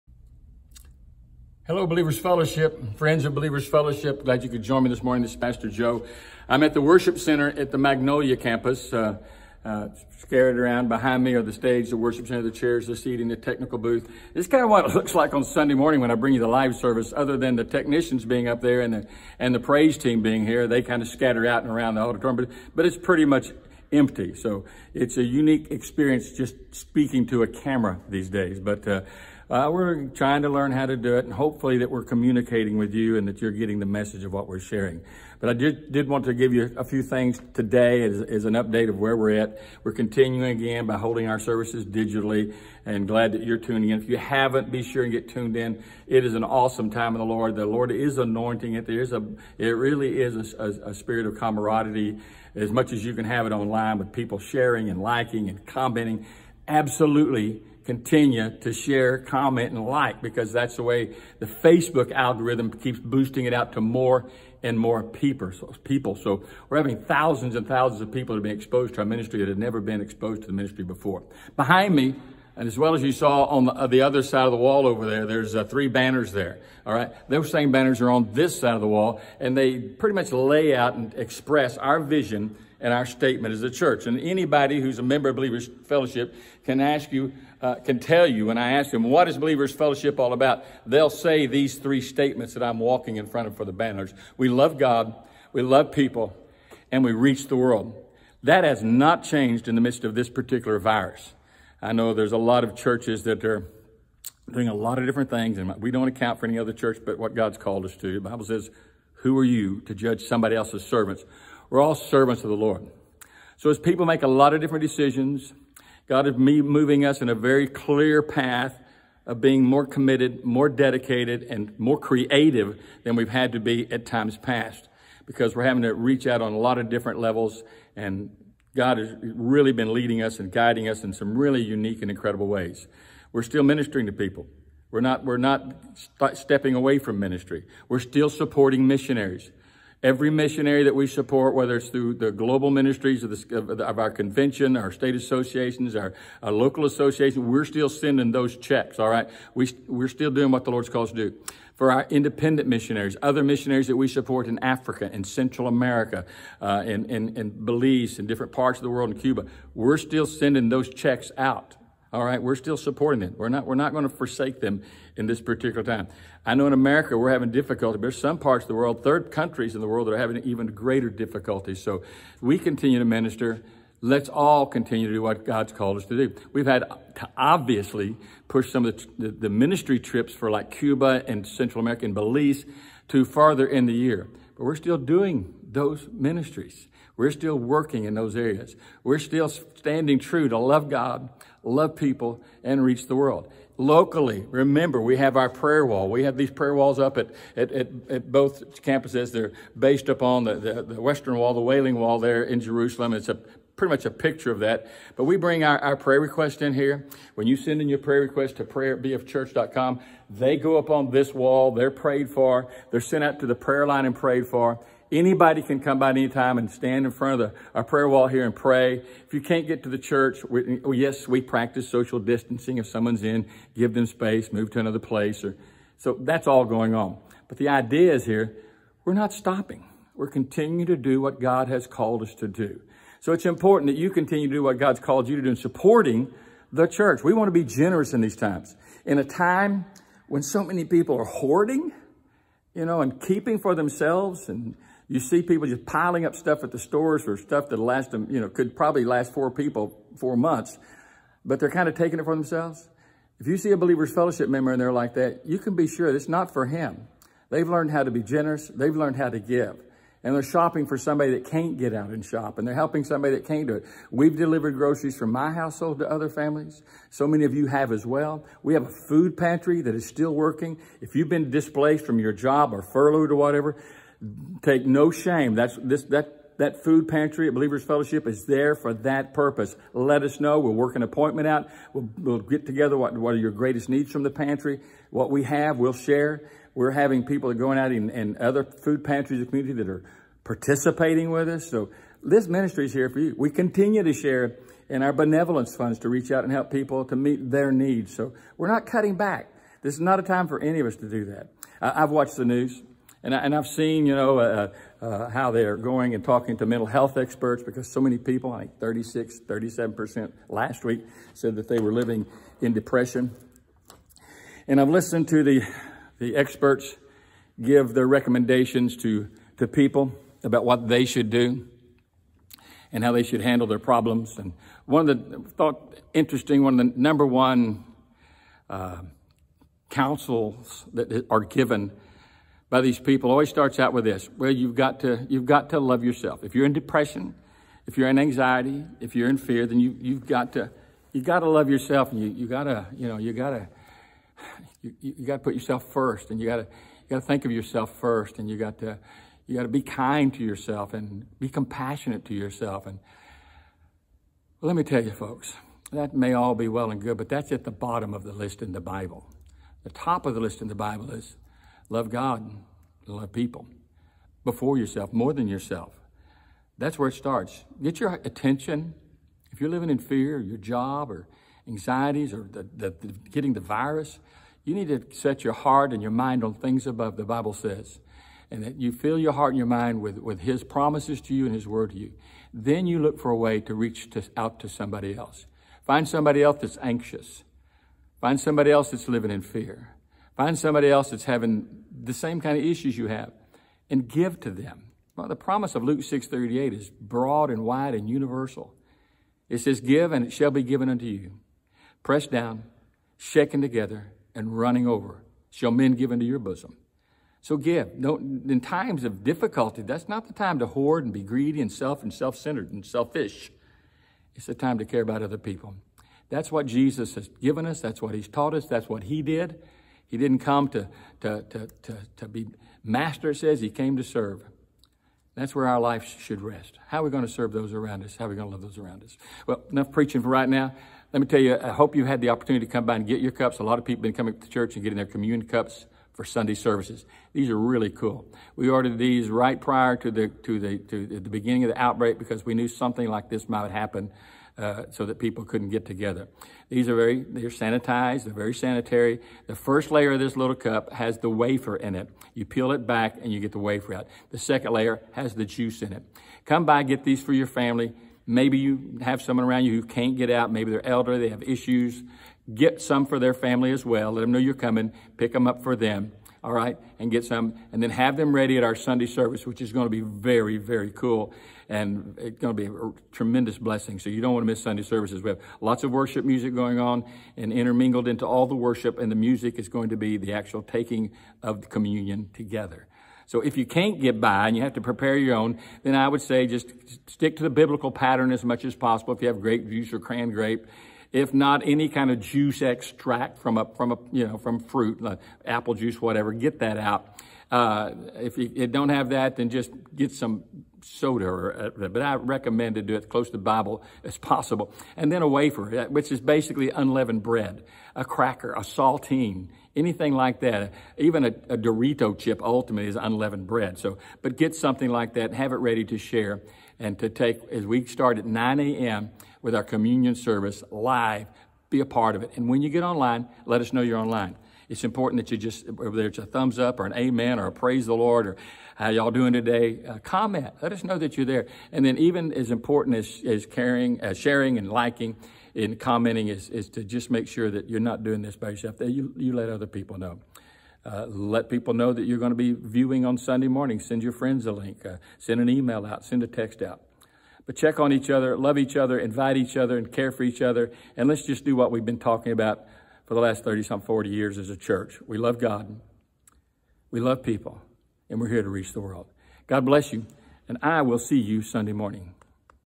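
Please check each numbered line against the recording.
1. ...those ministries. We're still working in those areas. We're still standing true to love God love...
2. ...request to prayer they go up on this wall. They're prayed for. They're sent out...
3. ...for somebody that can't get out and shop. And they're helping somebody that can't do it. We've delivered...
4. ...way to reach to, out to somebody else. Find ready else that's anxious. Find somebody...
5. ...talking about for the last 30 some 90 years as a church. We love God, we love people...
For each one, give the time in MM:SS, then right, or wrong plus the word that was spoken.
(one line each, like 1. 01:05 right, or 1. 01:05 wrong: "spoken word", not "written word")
1. 03:05 right
2. 03:28 right
3. 04:20 right
4. 06:23 wrong: "somebody", not "ready"
5. 09:11 wrong: "40", not "90".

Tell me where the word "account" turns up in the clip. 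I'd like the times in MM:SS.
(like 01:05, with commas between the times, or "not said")
01:46.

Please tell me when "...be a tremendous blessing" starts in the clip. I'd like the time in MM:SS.
07:52.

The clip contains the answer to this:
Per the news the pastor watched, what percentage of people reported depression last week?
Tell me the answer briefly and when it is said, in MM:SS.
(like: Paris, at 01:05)
36%, at 05:08.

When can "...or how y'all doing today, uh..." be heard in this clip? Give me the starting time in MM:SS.
08:48.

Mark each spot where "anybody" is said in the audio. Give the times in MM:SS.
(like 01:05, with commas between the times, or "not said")
01:24, 03:35.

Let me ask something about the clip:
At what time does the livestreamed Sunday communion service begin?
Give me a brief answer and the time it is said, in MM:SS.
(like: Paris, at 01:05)
9 a.m., at 08:38.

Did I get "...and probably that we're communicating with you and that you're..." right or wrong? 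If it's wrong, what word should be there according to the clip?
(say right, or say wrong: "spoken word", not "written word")
wrong: "hopefully", not "probably".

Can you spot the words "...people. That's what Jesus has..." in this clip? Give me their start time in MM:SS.
06:55.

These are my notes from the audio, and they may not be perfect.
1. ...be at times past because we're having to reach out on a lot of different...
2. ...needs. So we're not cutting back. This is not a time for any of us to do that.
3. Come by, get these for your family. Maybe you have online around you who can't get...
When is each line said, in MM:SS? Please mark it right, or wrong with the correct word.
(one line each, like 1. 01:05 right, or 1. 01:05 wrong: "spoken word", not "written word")
1. 02:03 right
2. 04:57 right
3. 07:36 wrong: "someone", not "online".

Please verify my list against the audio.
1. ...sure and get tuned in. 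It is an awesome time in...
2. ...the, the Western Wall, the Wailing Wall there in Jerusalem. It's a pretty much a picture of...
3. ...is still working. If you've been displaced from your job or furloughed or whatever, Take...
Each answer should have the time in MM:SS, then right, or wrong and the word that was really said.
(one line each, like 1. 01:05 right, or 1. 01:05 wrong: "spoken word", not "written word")
1. 00:44 right
2. 03:20 right
3. 04:29 right.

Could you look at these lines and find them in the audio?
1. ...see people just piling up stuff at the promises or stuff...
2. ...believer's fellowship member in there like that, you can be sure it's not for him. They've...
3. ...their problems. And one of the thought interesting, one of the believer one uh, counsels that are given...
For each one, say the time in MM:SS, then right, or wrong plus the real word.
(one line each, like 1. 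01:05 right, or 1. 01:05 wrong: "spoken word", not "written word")
1. 04:05 wrong: "stores", not "promises"
2. 04:13 right
3. 05:23 wrong: "number", not "believer".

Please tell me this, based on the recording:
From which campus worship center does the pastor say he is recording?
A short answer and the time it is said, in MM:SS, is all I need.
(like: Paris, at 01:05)
Magnolia, at 00:07.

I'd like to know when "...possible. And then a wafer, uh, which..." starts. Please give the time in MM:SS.
08:24.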